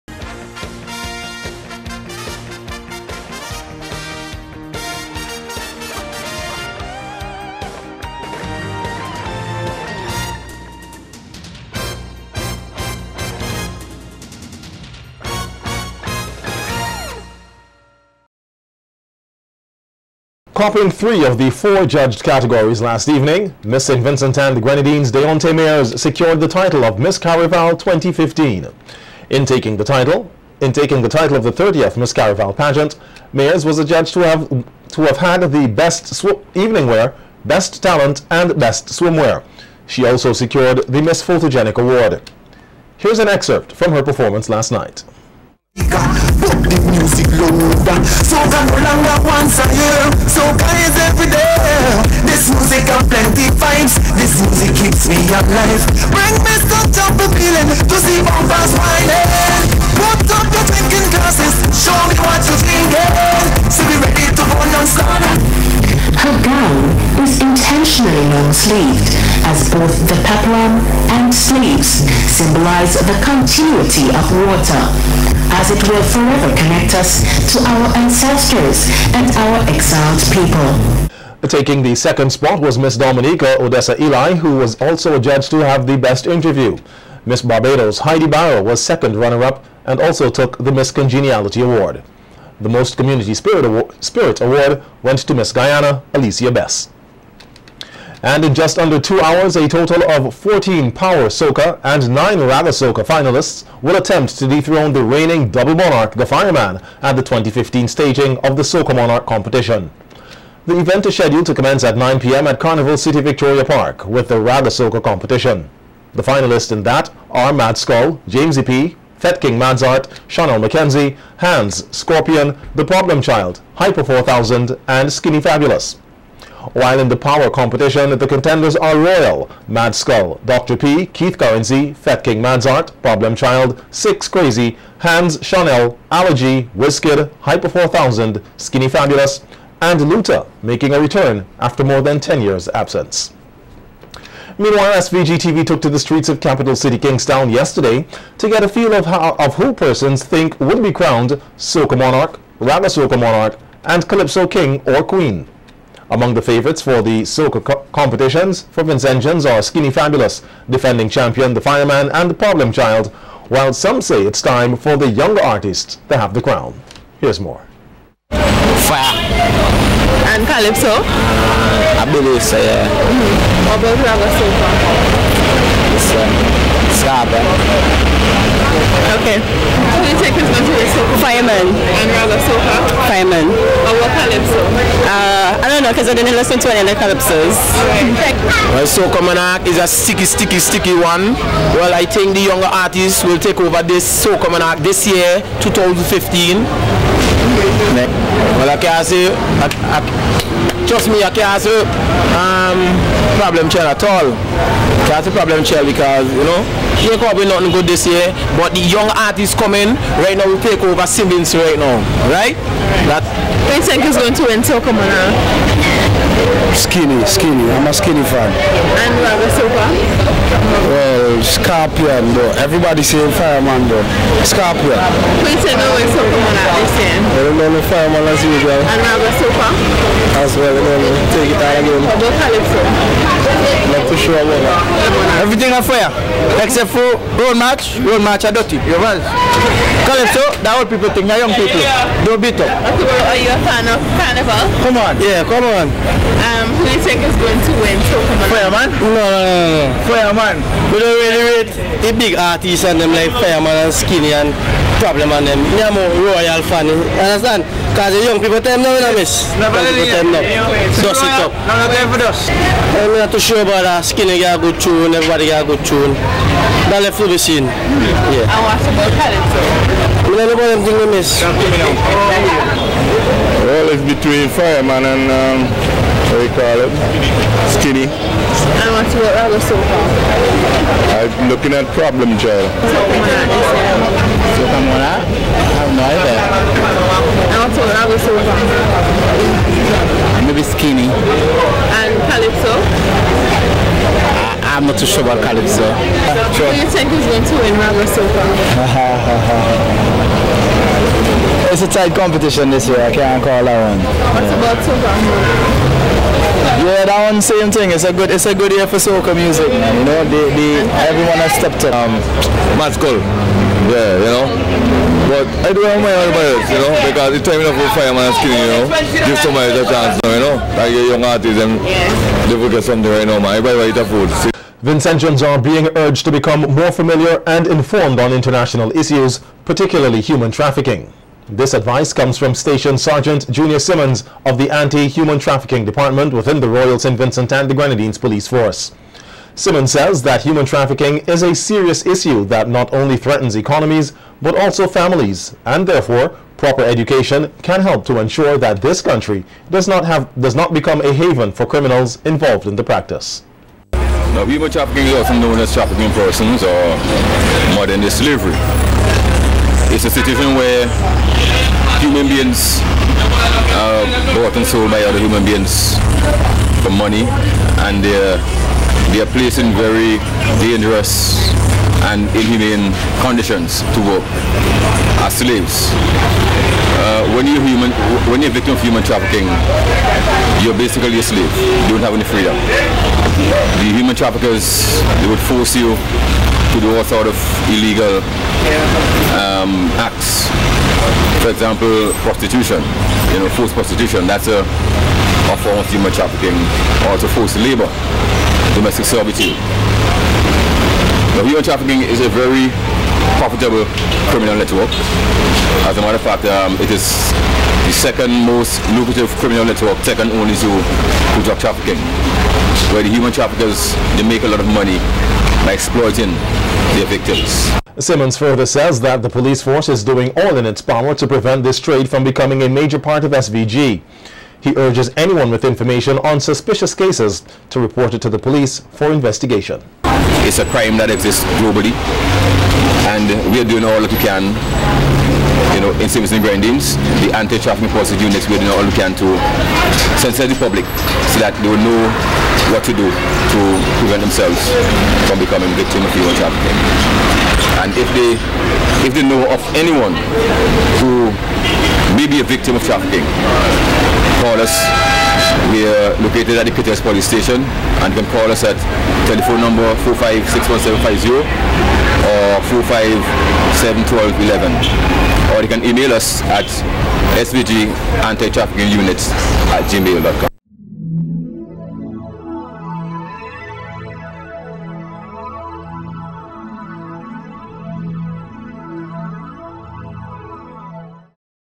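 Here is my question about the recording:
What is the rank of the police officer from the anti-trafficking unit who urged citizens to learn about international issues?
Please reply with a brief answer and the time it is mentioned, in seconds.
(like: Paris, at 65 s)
Station Sergeant, at 332 s.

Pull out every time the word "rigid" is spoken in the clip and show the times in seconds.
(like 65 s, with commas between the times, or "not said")
not said.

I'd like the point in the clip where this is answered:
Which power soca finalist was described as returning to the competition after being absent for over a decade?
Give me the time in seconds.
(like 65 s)
140 s.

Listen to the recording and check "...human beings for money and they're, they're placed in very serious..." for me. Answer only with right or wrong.
wrong.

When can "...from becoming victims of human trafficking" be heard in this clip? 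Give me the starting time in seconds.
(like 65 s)
445 s.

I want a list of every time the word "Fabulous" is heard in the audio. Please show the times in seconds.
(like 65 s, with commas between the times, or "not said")
125 s, 138 s, 159 s.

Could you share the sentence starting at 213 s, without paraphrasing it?
That Who you think is going to win Silka Skinny, skinny.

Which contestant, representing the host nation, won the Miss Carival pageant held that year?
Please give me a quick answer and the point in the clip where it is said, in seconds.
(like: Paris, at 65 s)
Deontay Mayers, at 25 s.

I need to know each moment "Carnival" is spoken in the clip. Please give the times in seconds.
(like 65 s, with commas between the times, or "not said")
112 s, 244 s.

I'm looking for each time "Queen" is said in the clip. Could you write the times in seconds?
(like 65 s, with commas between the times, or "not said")
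155 s.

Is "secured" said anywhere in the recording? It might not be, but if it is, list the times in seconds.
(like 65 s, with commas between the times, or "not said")
25 s, 40 s.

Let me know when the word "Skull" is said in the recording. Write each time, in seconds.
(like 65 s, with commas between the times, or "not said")
117 s, 129 s, 312 s.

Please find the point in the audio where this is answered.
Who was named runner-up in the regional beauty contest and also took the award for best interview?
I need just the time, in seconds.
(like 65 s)
83 s.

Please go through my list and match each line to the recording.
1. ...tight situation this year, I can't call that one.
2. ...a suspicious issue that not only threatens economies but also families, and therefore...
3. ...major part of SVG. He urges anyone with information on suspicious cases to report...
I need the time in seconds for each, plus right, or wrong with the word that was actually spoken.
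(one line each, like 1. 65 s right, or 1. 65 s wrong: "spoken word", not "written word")
1. 301 s wrong: "competition", not "situation"
2. 341 s wrong: "serious", not "suspicious"
3. 422 s right.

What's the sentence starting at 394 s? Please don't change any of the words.
That's a, a form of human trafficking, also forced labor, domestic servitude human trafficking is a very profitable criminal network.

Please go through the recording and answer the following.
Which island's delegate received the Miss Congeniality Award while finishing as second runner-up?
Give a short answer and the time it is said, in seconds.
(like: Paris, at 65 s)
Barbados, at 87 s.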